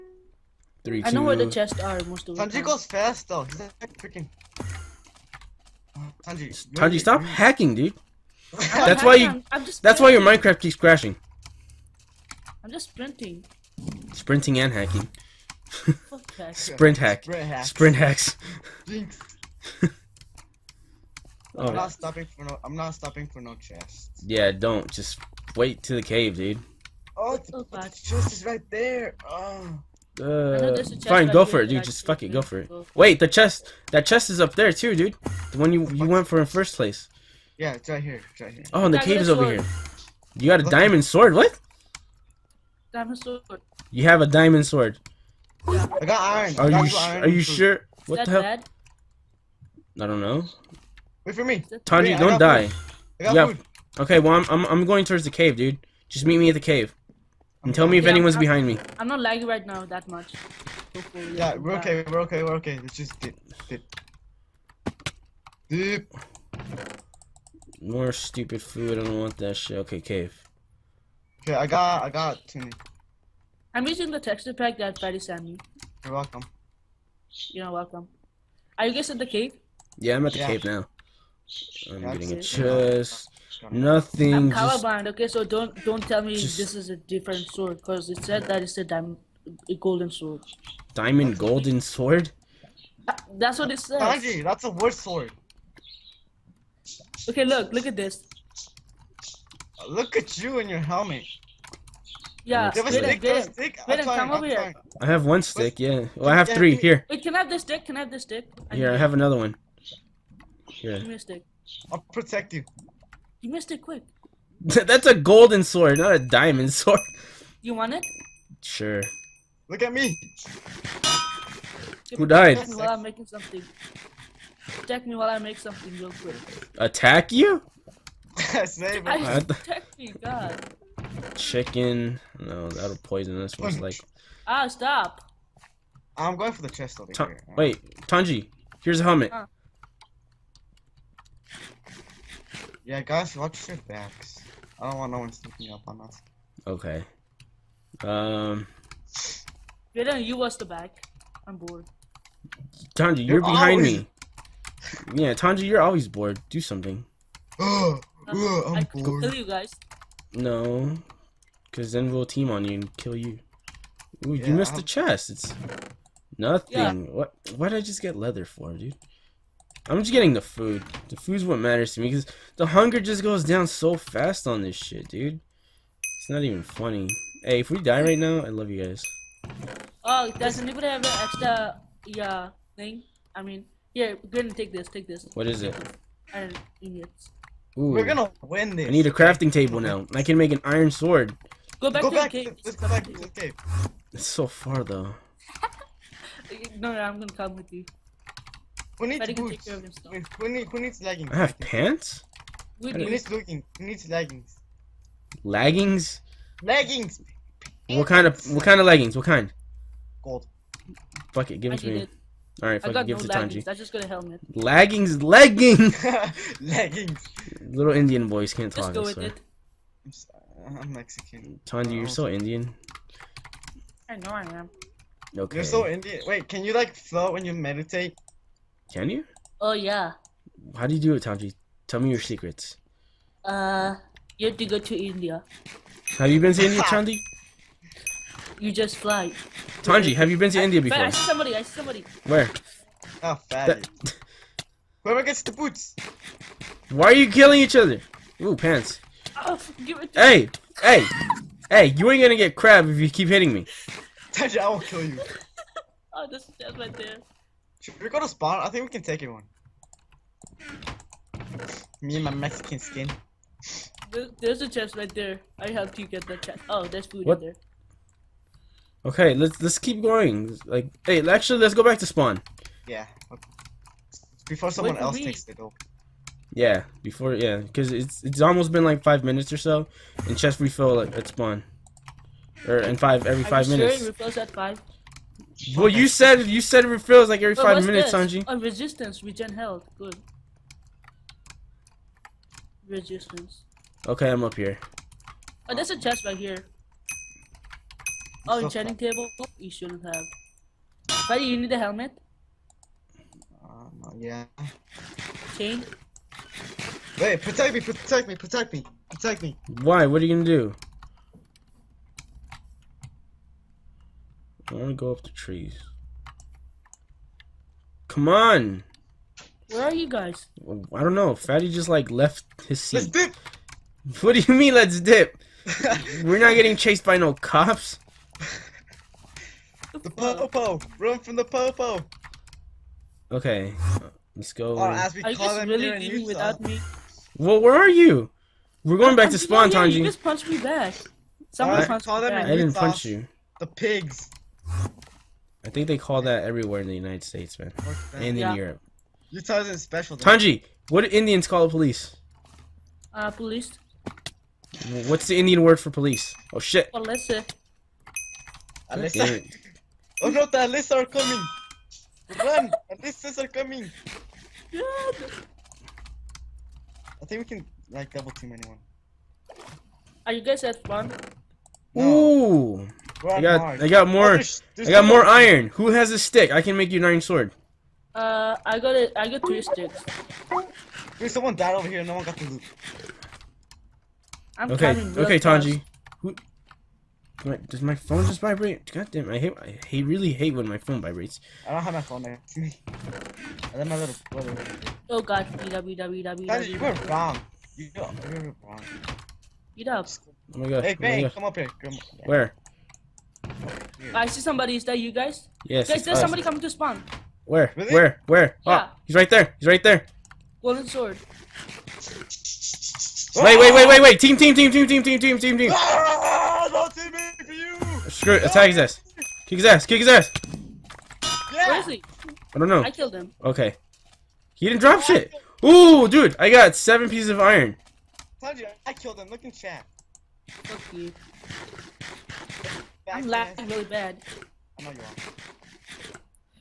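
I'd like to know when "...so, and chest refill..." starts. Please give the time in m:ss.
4:39.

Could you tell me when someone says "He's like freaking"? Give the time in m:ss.
0:03.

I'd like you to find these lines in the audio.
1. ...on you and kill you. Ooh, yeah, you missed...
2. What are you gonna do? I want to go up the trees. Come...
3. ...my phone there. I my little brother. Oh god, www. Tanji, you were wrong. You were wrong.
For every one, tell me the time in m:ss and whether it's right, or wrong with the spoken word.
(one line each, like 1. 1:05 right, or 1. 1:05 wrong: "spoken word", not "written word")
1. 2:42 right
2. 5:10 right
3. 6:31 right.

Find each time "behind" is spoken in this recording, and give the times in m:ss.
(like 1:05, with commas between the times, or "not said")
0:58, 2:33.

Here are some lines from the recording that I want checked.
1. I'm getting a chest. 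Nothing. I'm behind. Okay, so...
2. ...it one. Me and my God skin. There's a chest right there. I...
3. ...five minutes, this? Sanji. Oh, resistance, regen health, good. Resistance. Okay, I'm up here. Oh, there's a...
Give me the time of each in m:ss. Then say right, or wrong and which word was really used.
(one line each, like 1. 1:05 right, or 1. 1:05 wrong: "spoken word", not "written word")
1. 1:21 wrong: "colorblind", not "behind"
2. 4:19 wrong: "Mexican", not "God"
3. 4:47 right.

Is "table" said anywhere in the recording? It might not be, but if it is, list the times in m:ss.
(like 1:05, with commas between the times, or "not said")
3:09, 4:58.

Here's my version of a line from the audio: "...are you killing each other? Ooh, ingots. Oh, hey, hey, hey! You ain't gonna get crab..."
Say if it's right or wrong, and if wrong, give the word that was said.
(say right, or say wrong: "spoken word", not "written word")
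wrong: "pants", not "ingots".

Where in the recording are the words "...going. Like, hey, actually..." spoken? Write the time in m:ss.
4:30.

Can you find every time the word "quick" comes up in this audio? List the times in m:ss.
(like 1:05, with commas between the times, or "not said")
1:53, 2:06.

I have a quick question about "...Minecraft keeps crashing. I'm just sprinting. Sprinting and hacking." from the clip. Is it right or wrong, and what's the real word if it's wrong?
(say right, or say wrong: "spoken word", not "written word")
right.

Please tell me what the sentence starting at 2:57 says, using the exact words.
Hey, if we die right now, I love you guys.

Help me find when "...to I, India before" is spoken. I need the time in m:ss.
4:00.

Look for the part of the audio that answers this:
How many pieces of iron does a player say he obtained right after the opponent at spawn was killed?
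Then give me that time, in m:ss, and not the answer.
7:06.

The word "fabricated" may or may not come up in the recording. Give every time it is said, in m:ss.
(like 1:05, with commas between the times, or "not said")
not said.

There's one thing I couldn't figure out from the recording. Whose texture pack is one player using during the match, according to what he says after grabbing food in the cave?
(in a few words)
Freddy.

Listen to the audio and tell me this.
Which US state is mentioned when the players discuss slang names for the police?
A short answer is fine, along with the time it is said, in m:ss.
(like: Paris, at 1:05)
Utah, at 5:49.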